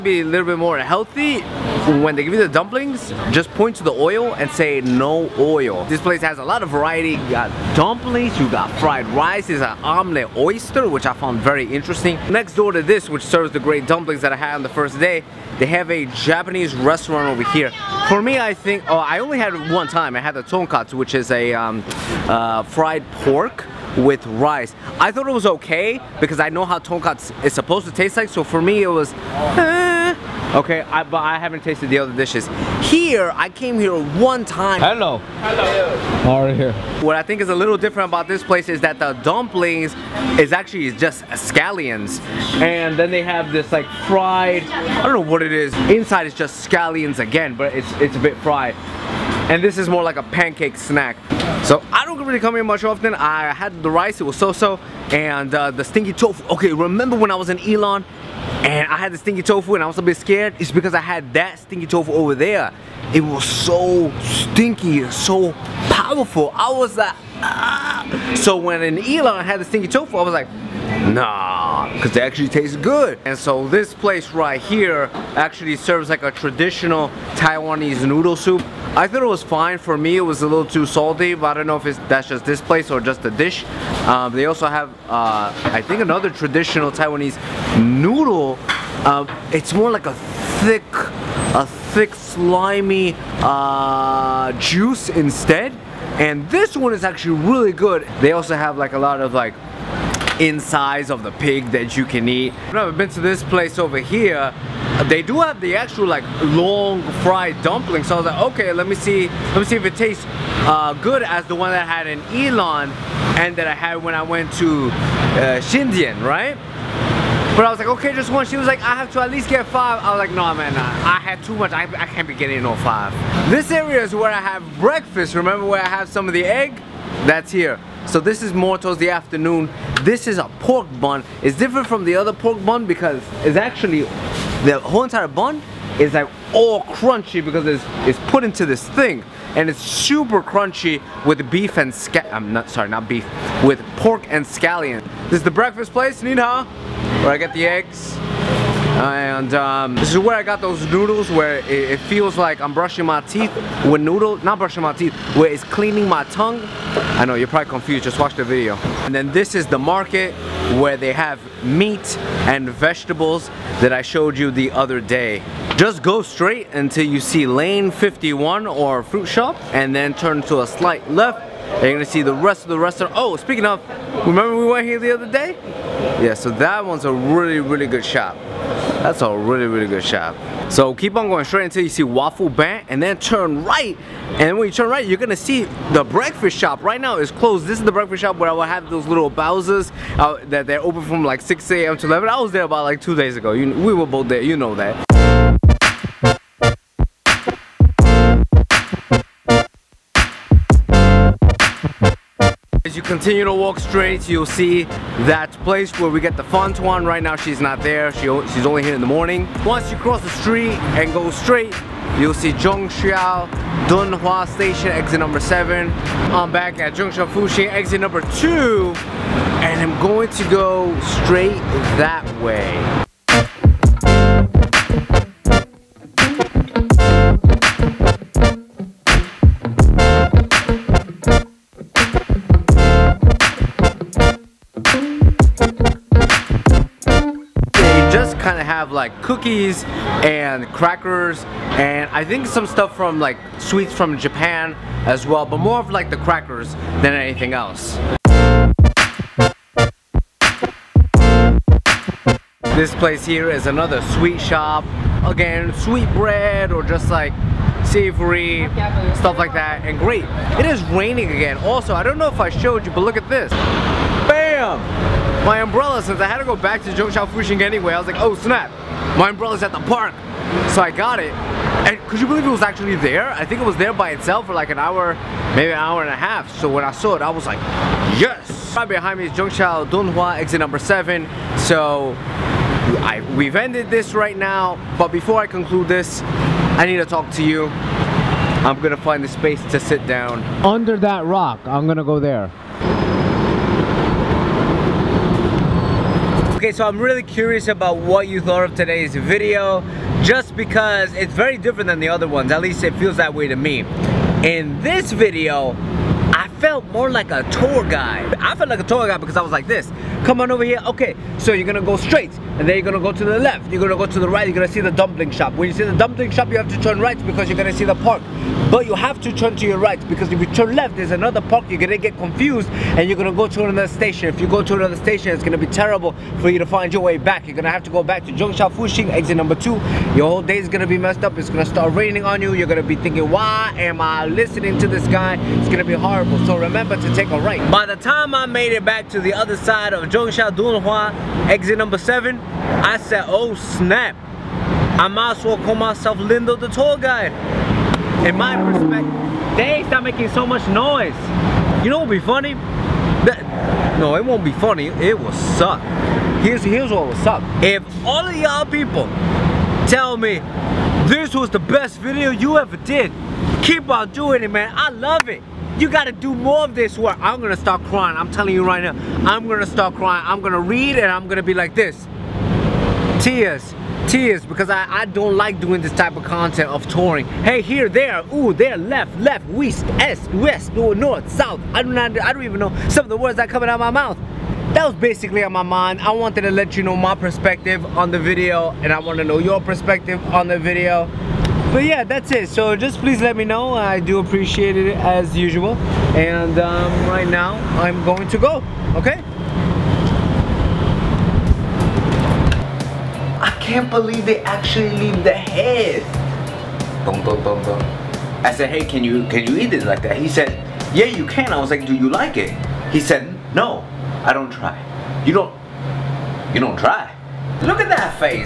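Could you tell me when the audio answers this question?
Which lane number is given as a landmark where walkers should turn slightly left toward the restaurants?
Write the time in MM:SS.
02:47.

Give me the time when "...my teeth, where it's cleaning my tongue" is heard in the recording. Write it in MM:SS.
02:34.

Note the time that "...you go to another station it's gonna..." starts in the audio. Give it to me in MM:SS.
05:24.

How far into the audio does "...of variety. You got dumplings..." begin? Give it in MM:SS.
00:06.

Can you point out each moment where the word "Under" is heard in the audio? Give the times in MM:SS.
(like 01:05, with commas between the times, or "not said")
04:50.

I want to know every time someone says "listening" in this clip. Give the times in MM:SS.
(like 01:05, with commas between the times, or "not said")
05:34.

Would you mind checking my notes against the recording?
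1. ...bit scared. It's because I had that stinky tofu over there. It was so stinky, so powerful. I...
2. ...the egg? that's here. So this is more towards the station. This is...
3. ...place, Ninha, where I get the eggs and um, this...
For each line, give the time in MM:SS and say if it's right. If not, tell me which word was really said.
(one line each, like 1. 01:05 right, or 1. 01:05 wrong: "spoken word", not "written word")
1. 01:00 right
2. 02:06 wrong: "afternoon", not "station"
3. 02:25 right.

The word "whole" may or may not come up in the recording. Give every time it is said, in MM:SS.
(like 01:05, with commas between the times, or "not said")
02:14, 05:30.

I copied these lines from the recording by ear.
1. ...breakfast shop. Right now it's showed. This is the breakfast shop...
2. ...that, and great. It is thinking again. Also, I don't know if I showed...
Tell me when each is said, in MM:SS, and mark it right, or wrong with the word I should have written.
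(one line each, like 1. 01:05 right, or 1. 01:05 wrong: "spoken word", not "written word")
1. 03:06 wrong: "closed", not "showed"
2. 04:19 wrong: "raining", not "thinking".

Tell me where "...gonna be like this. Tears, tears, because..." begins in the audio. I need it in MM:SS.
06:11.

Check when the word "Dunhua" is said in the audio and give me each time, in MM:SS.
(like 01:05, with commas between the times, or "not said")
03:33, 04:39.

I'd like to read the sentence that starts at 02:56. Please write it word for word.
Yeah, so that one's a really, really good shop.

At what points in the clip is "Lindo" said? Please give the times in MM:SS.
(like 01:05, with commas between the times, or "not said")
05:46.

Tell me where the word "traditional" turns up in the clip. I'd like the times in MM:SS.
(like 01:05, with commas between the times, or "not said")
01:16, 01:26.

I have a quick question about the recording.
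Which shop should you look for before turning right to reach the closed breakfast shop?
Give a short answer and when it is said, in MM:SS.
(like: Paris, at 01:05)
Waffle Bank, at 03:02.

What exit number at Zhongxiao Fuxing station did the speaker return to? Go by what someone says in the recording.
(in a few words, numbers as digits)
2.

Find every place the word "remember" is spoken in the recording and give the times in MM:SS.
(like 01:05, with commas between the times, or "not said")
00:56, 02:05, 02:54, 05:36.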